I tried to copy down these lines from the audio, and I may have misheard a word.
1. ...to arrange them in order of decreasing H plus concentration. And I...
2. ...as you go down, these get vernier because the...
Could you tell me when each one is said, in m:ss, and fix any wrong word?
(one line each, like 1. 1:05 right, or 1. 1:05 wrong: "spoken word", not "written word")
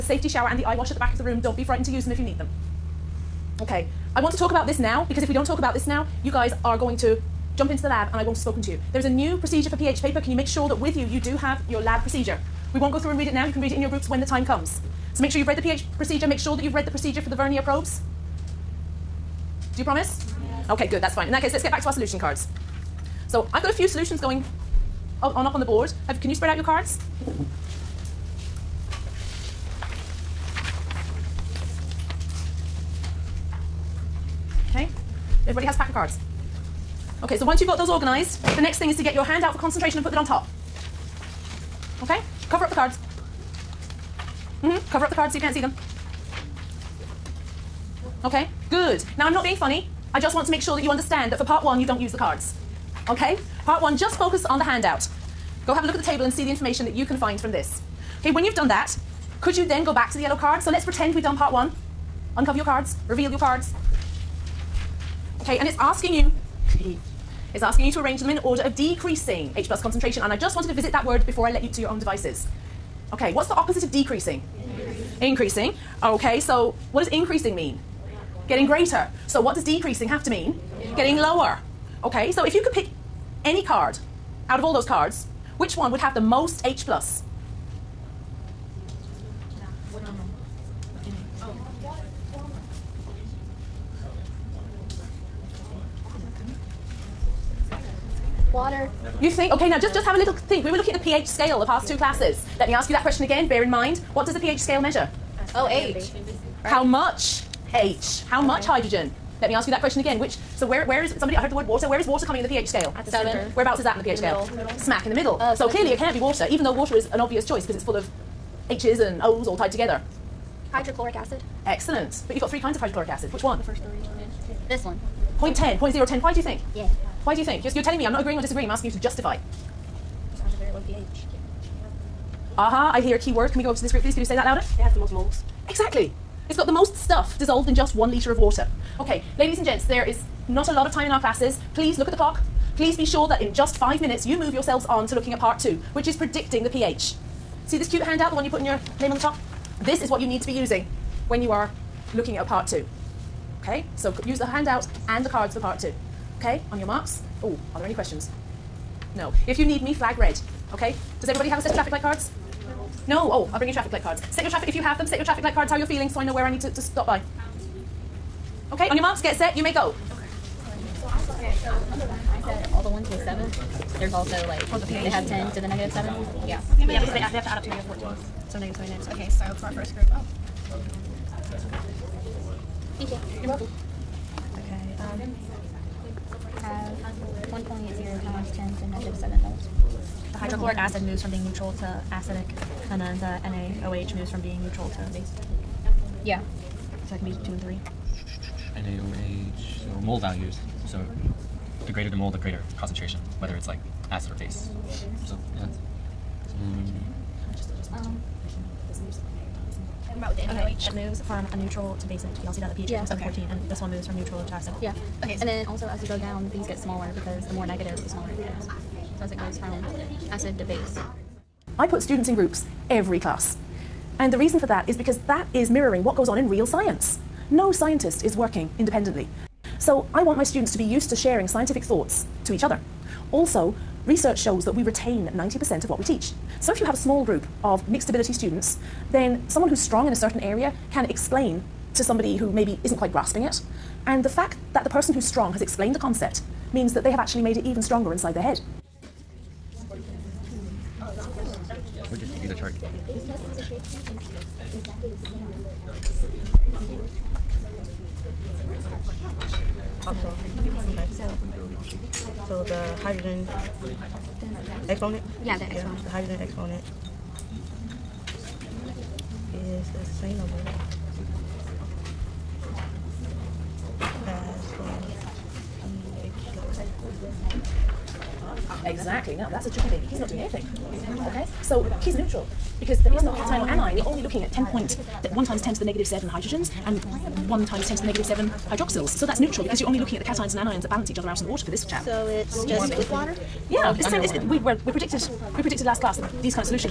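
1. 1:07 right
2. 3:35 wrong: "smaller", not "vernier".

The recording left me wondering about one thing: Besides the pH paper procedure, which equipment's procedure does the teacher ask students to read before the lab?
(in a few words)
Vernier probes.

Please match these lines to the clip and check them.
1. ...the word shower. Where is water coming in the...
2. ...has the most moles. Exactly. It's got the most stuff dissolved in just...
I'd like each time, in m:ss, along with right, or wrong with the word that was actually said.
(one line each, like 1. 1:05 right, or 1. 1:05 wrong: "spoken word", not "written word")
1. 1:51 wrong: "water", not "shower"
2. 2:14 right.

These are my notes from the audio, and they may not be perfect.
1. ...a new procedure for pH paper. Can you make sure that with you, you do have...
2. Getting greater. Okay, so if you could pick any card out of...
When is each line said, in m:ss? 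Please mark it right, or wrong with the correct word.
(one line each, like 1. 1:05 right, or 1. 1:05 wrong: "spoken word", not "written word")
1. 0:09 right
2. 1:20 wrong: "lower", not "greater".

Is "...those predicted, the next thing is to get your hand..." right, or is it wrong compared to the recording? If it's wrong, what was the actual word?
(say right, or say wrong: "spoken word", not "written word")
wrong: "organized", not "predicted".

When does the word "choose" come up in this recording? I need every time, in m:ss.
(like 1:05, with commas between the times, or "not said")
not said.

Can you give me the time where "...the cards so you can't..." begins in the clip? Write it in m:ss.
0:45.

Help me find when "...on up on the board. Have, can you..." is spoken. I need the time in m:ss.
0:25.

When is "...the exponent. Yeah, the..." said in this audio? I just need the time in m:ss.
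4:25.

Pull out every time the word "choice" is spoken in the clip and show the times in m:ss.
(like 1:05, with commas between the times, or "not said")
1:57.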